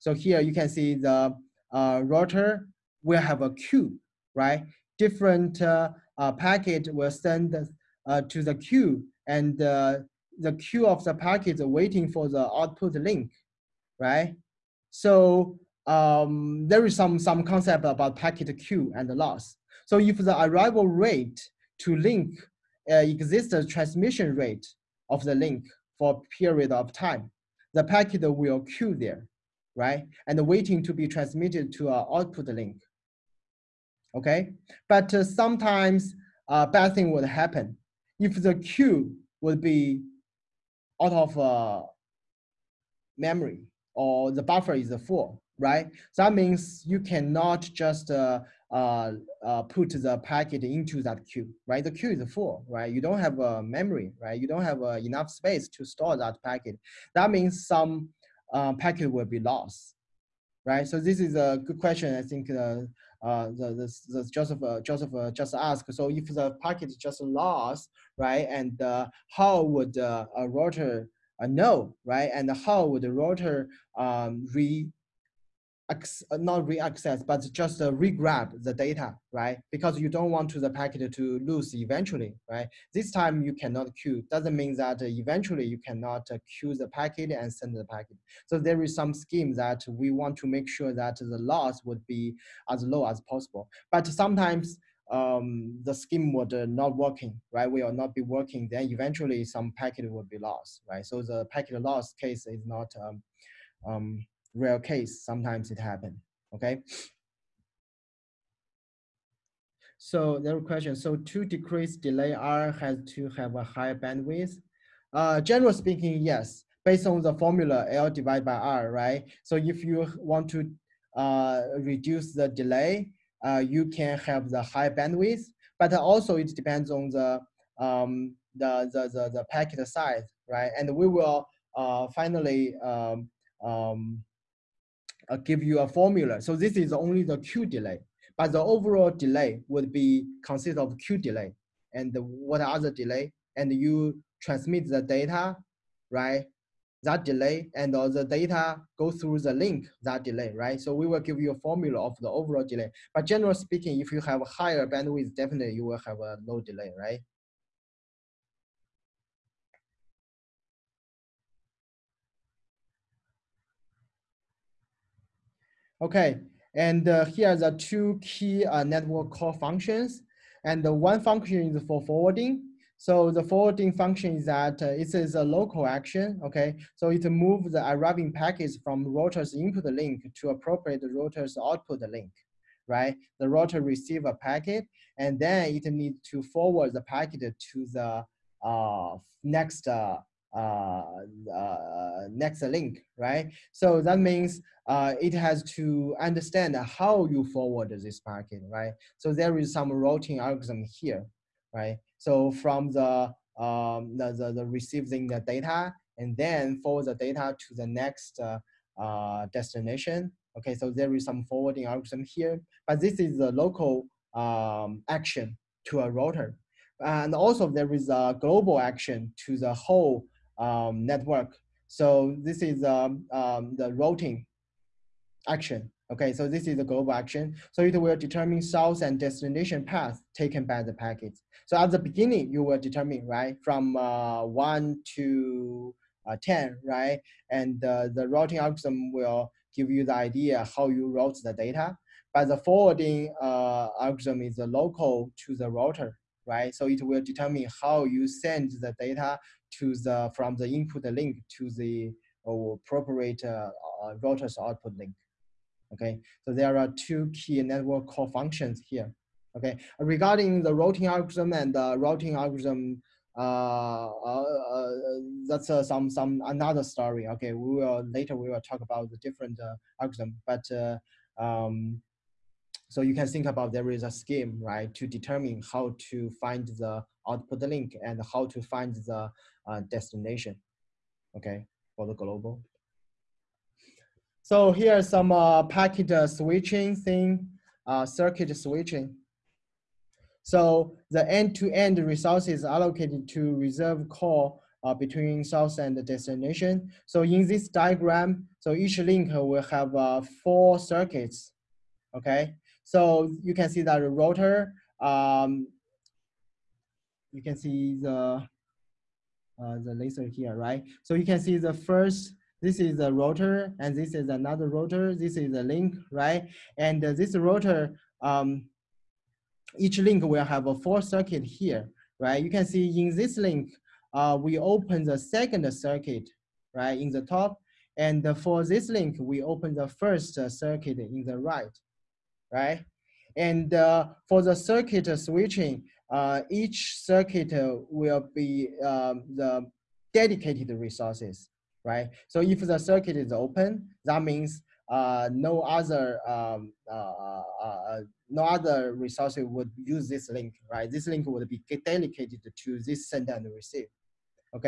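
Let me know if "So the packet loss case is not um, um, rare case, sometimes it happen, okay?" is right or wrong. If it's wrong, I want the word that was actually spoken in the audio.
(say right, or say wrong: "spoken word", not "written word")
right.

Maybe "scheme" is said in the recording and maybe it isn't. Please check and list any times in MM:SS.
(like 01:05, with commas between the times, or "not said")
01:29, 01:35, 04:34.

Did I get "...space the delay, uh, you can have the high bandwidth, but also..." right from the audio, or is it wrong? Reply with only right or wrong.
wrong.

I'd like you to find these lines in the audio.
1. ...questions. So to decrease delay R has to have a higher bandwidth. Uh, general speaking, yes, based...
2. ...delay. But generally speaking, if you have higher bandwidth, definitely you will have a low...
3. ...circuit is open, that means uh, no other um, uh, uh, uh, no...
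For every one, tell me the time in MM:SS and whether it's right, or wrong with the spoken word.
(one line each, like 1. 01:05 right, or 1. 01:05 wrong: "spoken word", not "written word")
1. 01:50 right
2. 02:32 right
3. 05:42 right.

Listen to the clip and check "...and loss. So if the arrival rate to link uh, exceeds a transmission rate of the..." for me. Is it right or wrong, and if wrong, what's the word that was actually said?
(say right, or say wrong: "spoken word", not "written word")
right.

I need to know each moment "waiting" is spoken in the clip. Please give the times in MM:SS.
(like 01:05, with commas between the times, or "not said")
00:11, 00:30.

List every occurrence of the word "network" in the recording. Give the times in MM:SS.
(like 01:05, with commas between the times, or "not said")
02:48, 03:41, 04:17.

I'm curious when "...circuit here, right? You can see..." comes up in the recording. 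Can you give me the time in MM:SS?
05:21.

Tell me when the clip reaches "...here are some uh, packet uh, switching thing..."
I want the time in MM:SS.
04:44.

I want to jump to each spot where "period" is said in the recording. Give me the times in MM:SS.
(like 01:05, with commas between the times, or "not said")
00:26.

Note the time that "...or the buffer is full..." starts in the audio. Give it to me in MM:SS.
00:43.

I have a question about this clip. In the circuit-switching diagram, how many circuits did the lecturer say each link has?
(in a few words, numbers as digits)
4.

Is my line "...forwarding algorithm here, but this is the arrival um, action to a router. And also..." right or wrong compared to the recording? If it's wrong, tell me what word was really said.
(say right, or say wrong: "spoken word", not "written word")
wrong: "local", not "arrival".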